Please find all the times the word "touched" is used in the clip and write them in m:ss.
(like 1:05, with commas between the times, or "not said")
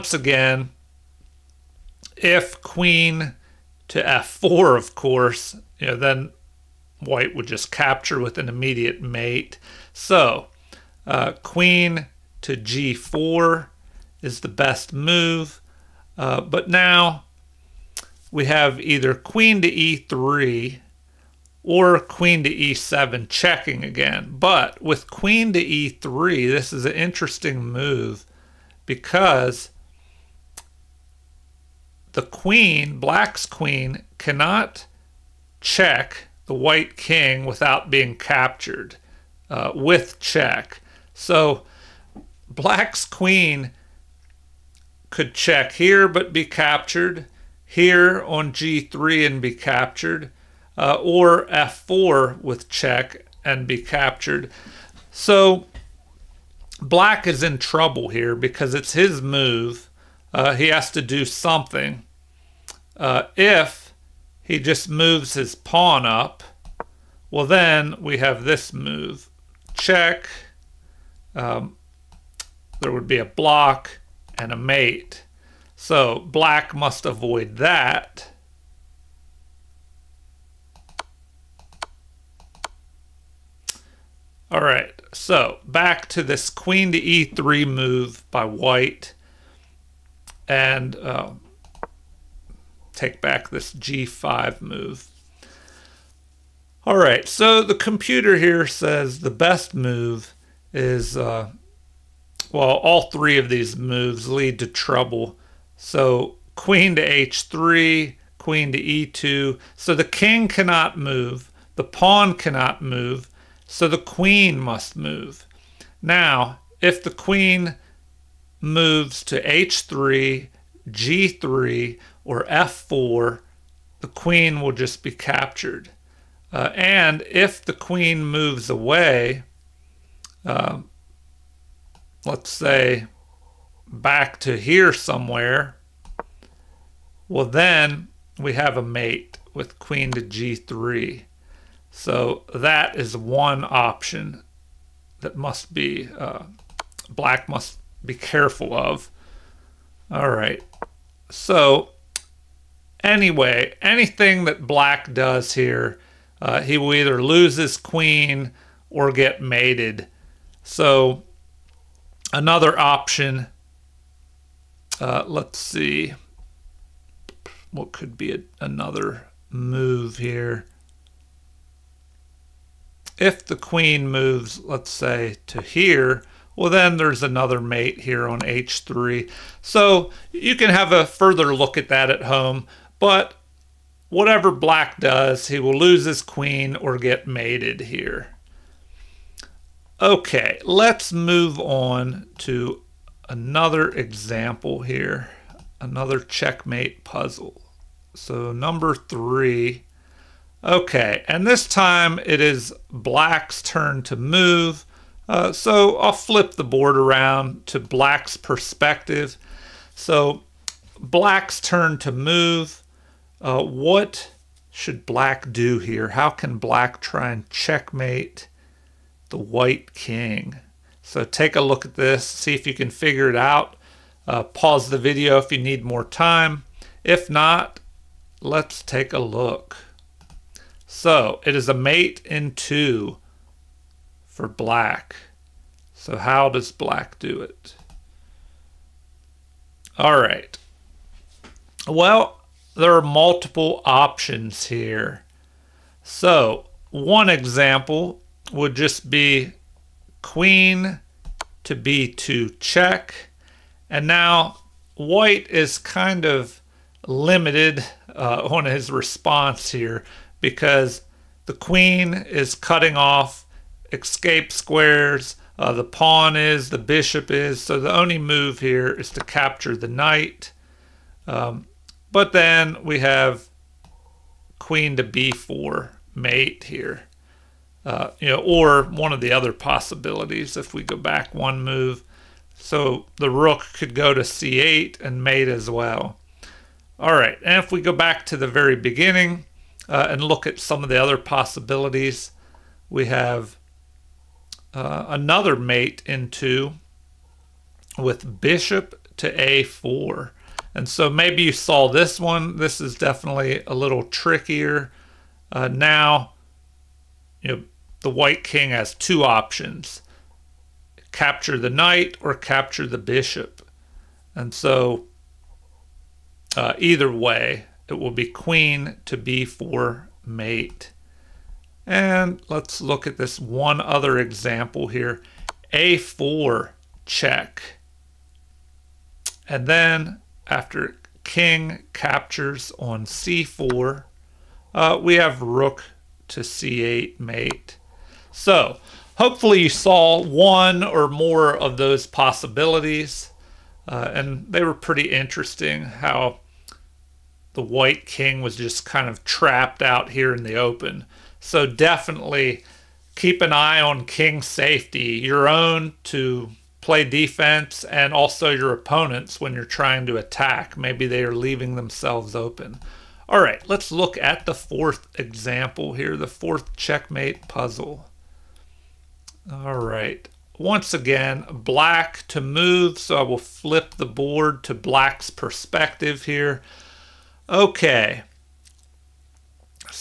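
not said.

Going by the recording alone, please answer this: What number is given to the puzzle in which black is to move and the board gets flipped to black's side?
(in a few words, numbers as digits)
3.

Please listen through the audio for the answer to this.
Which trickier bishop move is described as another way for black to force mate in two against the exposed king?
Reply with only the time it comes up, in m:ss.
4:58.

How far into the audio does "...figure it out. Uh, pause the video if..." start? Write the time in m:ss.
3:42.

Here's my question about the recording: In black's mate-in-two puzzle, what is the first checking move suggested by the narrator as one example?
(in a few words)
Queen to b2.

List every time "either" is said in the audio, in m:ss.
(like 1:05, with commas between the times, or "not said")
0:18, 2:36, 5:16.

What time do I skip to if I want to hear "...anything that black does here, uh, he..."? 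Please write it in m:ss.
2:33.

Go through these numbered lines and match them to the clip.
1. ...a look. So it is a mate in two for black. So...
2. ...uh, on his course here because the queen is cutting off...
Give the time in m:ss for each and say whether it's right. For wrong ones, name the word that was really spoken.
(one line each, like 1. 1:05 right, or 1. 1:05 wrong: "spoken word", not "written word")
1. 3:49 right
2. 4:18 wrong: "response", not "course".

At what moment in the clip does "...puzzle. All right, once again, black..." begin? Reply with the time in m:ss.
6:07.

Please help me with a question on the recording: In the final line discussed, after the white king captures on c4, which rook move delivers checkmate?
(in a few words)
Rook to c8.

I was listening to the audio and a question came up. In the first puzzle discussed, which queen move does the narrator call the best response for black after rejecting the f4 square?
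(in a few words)
Queen to g4.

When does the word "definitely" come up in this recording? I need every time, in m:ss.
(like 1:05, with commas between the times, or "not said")
5:02, 5:51.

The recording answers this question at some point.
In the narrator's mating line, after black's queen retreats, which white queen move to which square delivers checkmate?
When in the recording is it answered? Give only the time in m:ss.
2:19.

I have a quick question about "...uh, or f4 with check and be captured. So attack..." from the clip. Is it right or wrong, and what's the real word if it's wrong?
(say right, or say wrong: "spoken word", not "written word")
wrong: "black", not "attack".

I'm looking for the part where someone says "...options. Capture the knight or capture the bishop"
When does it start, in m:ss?
5:09.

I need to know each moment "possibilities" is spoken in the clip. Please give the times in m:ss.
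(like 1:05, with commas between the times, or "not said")
4:39, 4:51, 5:42.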